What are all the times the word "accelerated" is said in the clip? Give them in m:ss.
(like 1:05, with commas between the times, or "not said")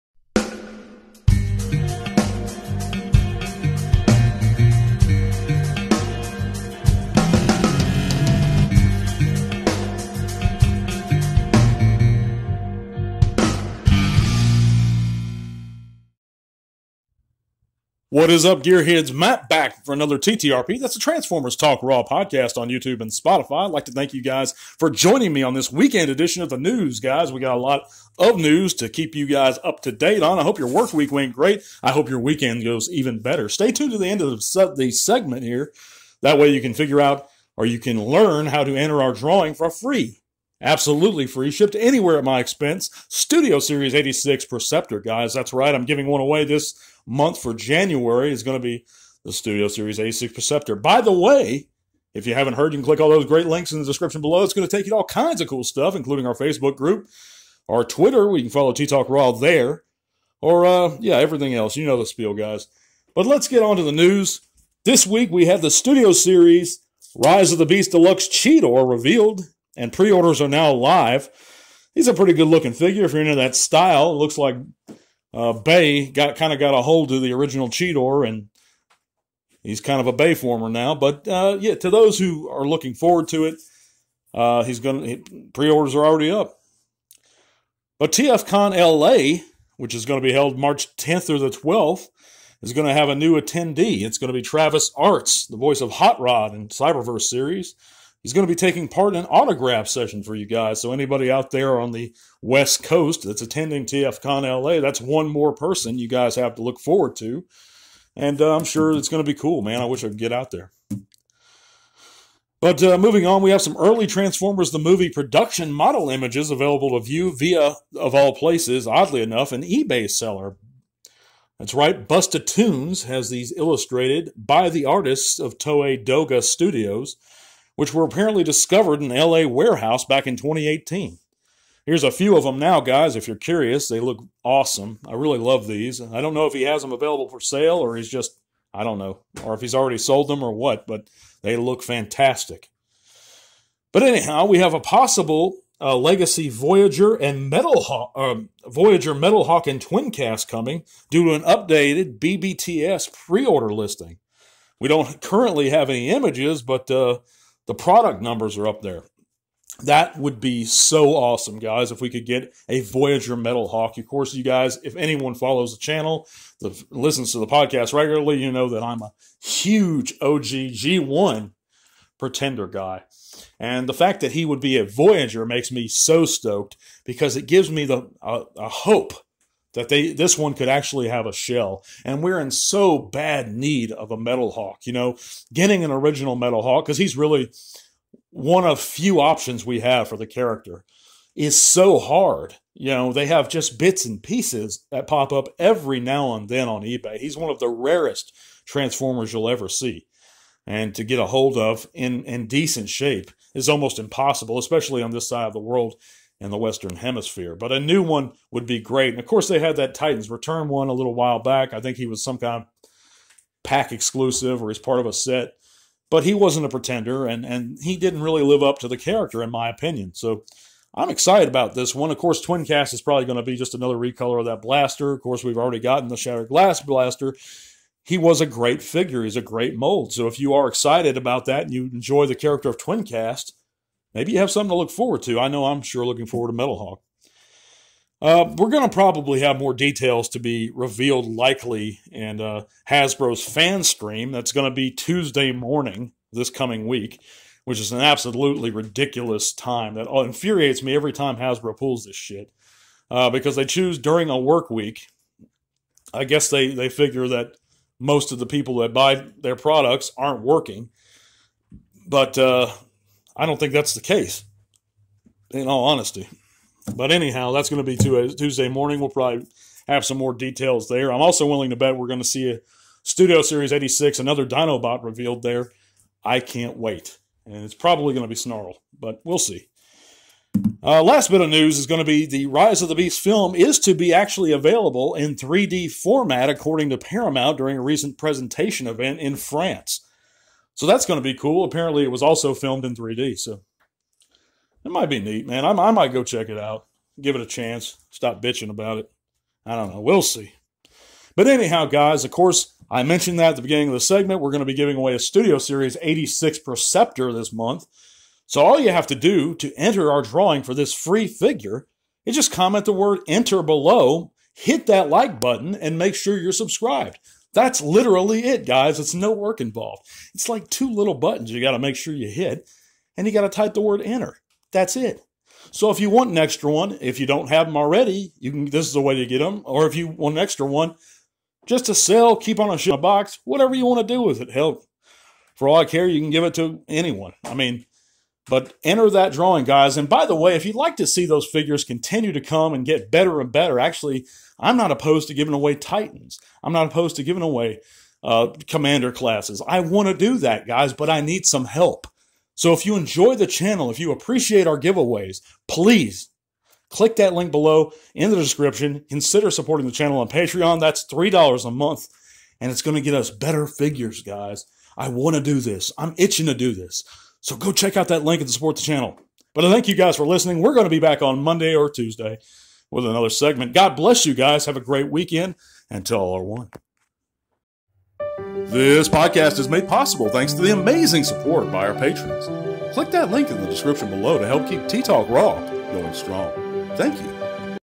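not said.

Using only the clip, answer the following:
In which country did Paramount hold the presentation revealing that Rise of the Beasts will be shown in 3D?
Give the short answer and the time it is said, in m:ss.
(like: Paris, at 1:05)
France, at 4:49.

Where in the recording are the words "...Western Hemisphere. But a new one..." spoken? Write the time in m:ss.
3:26.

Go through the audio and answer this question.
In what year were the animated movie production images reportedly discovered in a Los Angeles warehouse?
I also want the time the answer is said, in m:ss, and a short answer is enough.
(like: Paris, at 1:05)
2018, at 2:10.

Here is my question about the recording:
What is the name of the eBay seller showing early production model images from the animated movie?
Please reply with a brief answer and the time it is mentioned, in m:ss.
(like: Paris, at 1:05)
Busta Tunes, at 2:02.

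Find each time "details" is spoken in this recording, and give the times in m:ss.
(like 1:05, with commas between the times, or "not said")
3:59, 4:30.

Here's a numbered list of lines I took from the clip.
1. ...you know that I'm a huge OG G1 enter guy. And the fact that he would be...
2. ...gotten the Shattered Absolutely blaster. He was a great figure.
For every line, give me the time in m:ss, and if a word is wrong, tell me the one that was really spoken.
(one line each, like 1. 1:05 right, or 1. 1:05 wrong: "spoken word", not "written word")
1. 2:48 wrong: "pretender", not "enter"
2. 3:45 wrong: "Glass", not "Absolutely".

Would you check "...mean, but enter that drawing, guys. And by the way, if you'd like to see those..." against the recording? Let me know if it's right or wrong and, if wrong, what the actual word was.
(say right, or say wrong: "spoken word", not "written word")
right.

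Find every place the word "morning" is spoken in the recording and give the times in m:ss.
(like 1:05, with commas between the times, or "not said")
4:05, 4:28.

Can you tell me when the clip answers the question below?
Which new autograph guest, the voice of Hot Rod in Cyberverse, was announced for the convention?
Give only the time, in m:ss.
1:34.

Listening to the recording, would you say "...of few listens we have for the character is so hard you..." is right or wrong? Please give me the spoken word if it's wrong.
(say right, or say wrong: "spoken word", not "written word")
wrong: "options", not "listens".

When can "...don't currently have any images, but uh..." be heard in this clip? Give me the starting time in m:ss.
2:34.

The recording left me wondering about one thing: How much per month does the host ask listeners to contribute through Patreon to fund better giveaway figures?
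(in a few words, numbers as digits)
$3.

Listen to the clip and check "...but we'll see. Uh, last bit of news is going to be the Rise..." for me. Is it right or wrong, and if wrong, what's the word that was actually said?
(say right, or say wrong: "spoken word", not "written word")
right.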